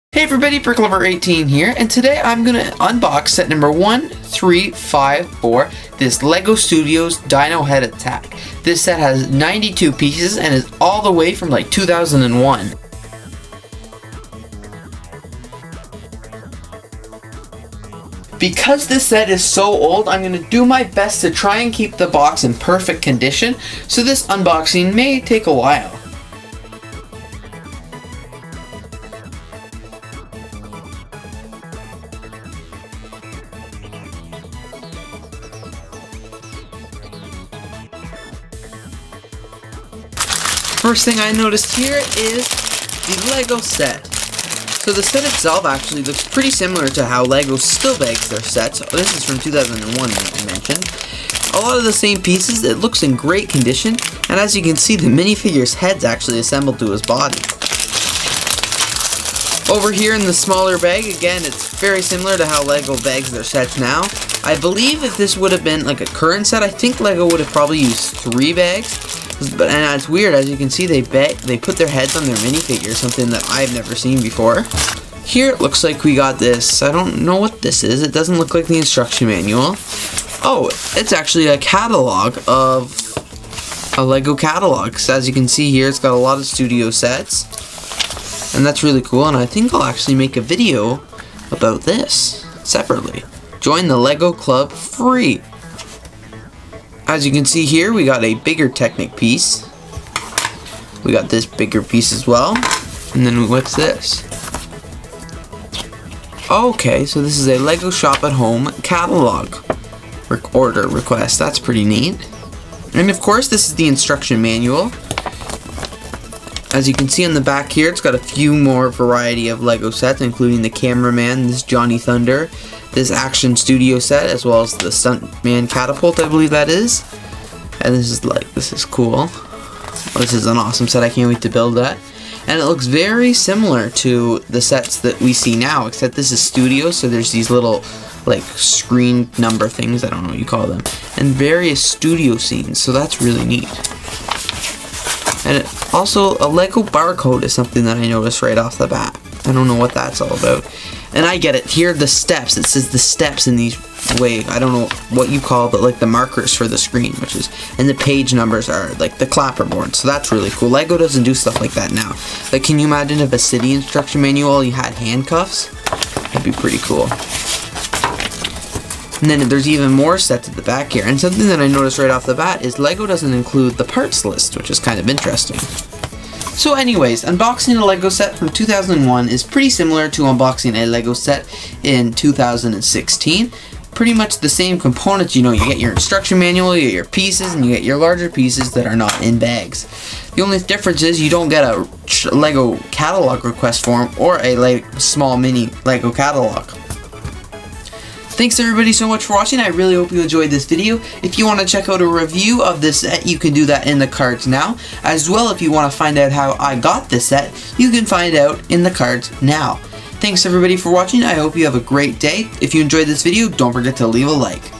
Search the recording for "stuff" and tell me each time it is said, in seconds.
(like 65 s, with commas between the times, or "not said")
161 s.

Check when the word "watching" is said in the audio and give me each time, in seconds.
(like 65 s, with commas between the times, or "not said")
199 s, 210 s.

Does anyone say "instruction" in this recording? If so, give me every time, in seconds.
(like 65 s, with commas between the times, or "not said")
78 s, 113 s, 163 s, 185 s.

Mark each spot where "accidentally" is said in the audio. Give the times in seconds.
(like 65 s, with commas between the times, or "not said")
not said.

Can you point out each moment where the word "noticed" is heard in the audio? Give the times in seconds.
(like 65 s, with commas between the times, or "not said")
41 s, 148 s, 171 s.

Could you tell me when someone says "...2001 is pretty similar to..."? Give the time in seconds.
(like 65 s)
178 s.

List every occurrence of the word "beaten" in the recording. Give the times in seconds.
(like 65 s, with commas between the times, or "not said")
not said.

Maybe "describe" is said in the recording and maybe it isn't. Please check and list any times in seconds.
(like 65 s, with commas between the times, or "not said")
not said.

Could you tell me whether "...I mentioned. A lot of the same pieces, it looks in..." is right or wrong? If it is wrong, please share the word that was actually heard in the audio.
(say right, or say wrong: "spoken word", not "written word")
right.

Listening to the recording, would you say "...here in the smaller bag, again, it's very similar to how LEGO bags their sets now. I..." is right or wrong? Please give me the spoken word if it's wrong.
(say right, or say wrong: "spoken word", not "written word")
right.